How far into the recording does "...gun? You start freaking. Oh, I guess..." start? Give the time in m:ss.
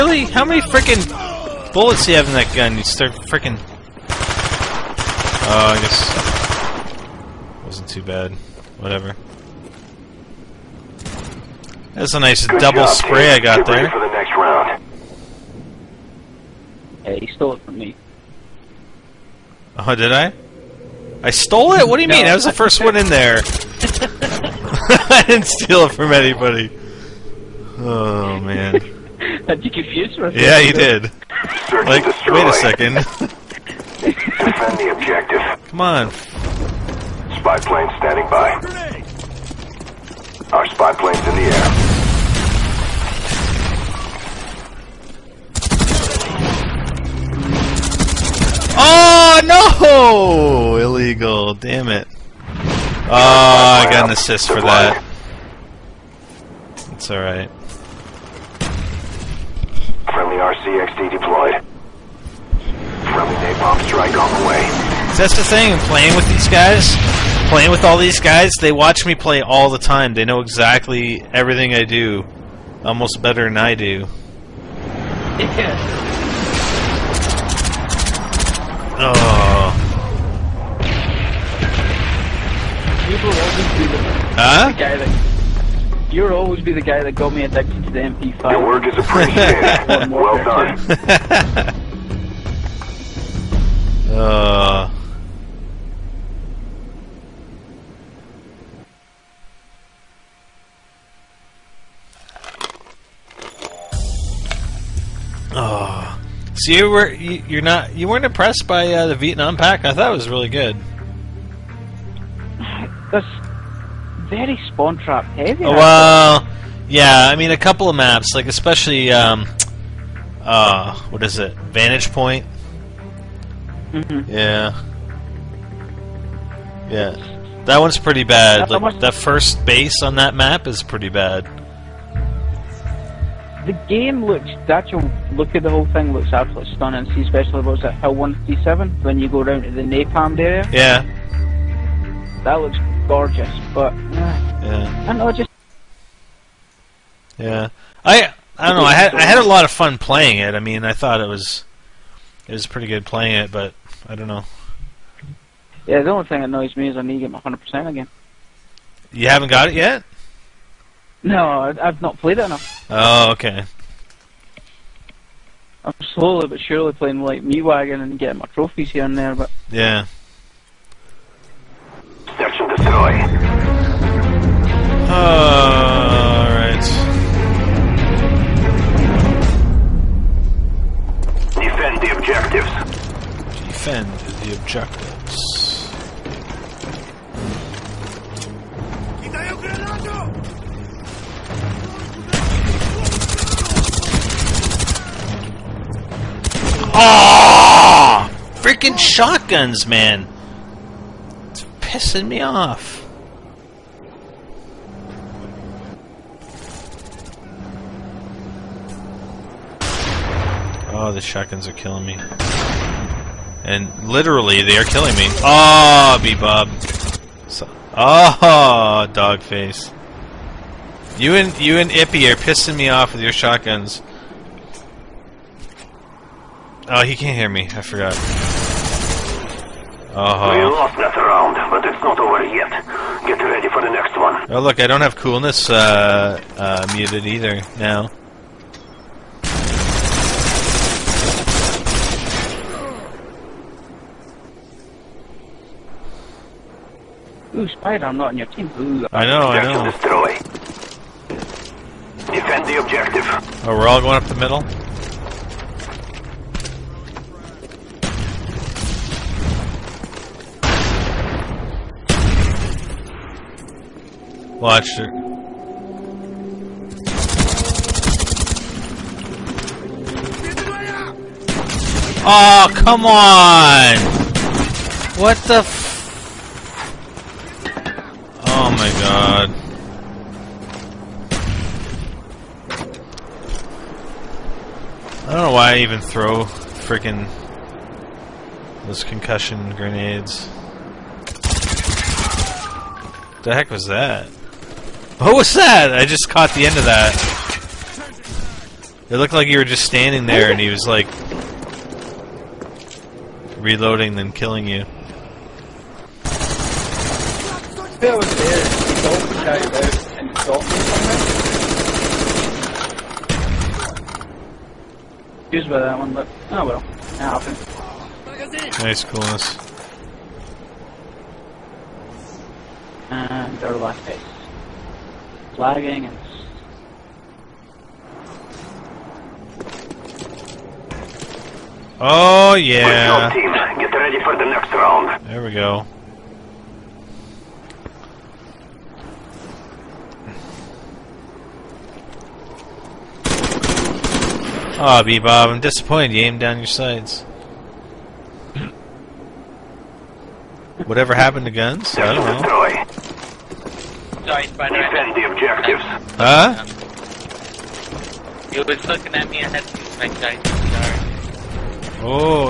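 0:02.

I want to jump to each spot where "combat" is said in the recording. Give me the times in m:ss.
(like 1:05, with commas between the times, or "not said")
not said.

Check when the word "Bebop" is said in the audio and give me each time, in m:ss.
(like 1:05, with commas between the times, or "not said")
3:36, 5:45.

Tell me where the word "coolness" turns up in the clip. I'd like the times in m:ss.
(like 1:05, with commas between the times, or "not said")
3:55, 5:19.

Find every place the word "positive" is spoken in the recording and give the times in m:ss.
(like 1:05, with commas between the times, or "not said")
not said.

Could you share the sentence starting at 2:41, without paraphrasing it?
No, I've not played it enough.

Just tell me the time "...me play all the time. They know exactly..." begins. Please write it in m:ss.
1:09.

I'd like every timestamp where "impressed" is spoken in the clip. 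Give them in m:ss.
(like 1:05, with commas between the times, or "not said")
1:48.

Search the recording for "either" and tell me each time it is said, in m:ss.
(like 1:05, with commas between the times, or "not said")
3:57.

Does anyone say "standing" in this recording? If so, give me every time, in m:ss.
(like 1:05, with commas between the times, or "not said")
0:37, 4:59.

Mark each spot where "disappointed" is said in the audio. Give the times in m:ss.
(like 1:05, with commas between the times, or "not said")
5:45.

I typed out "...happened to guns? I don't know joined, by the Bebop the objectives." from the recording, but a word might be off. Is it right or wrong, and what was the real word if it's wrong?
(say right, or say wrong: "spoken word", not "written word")
wrong: "Defend", not "Bebop".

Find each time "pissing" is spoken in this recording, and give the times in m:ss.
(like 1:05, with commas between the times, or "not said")
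3:21, 3:42.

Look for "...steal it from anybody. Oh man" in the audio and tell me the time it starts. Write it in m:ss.
0:25.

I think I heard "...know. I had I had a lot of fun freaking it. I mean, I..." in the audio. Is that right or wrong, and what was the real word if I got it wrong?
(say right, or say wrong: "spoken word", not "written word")
wrong: "playing", not "freaking".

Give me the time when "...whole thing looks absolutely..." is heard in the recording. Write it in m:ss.
2:15.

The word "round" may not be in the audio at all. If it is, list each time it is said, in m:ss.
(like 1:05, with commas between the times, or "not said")
0:14, 3:51, 5:34.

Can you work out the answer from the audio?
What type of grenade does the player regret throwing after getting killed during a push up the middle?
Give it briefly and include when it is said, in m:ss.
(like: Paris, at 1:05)
Concussion grenades, at 4:49.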